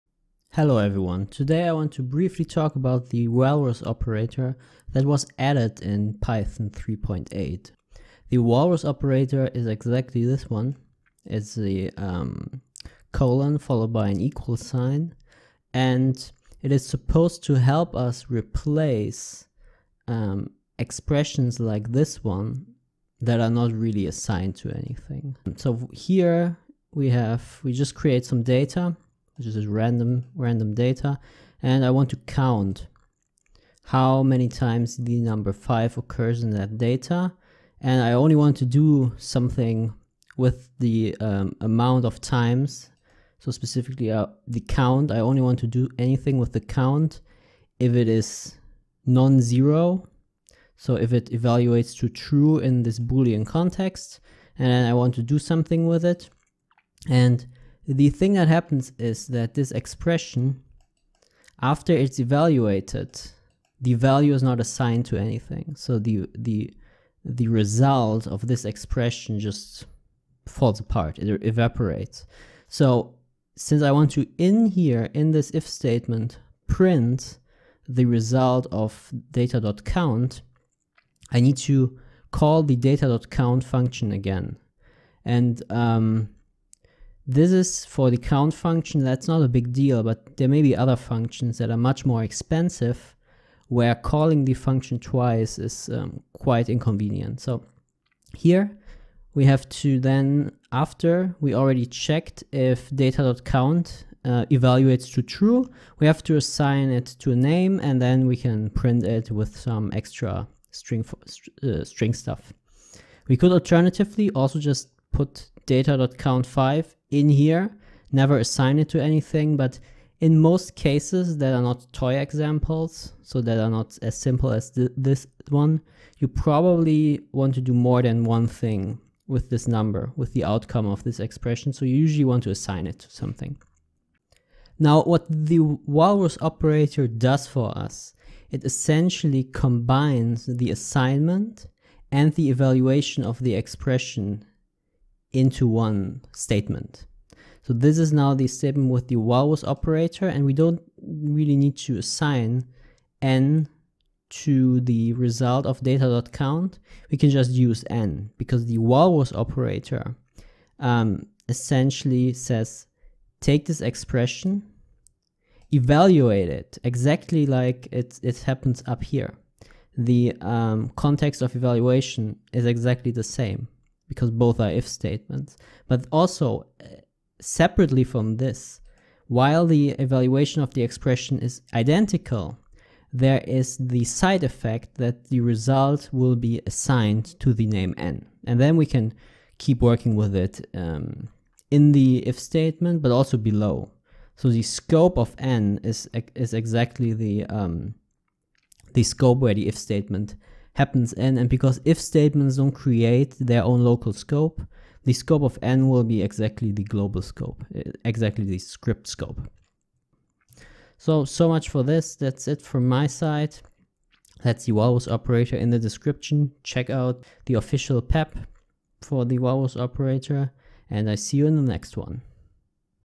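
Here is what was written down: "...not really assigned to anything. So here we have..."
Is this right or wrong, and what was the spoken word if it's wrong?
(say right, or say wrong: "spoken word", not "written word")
right.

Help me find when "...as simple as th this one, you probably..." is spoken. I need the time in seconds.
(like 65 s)
124 s.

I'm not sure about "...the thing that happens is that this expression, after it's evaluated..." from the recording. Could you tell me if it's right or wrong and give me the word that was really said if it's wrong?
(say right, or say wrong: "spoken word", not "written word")
right.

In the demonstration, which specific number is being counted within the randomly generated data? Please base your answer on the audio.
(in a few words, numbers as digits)
5.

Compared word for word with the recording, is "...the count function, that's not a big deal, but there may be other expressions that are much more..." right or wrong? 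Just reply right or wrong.
wrong.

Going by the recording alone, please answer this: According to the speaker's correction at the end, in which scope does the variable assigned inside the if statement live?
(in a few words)
script scope.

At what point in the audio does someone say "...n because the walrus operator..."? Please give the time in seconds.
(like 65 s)
157 s.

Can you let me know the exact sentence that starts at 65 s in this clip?
So the, the, the result of this expression just falls apart, it evaporates.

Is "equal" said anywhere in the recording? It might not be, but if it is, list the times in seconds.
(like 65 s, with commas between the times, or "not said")
14 s.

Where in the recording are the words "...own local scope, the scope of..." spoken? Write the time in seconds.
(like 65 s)
203 s.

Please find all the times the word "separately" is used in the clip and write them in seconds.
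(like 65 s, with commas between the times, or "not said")
177 s.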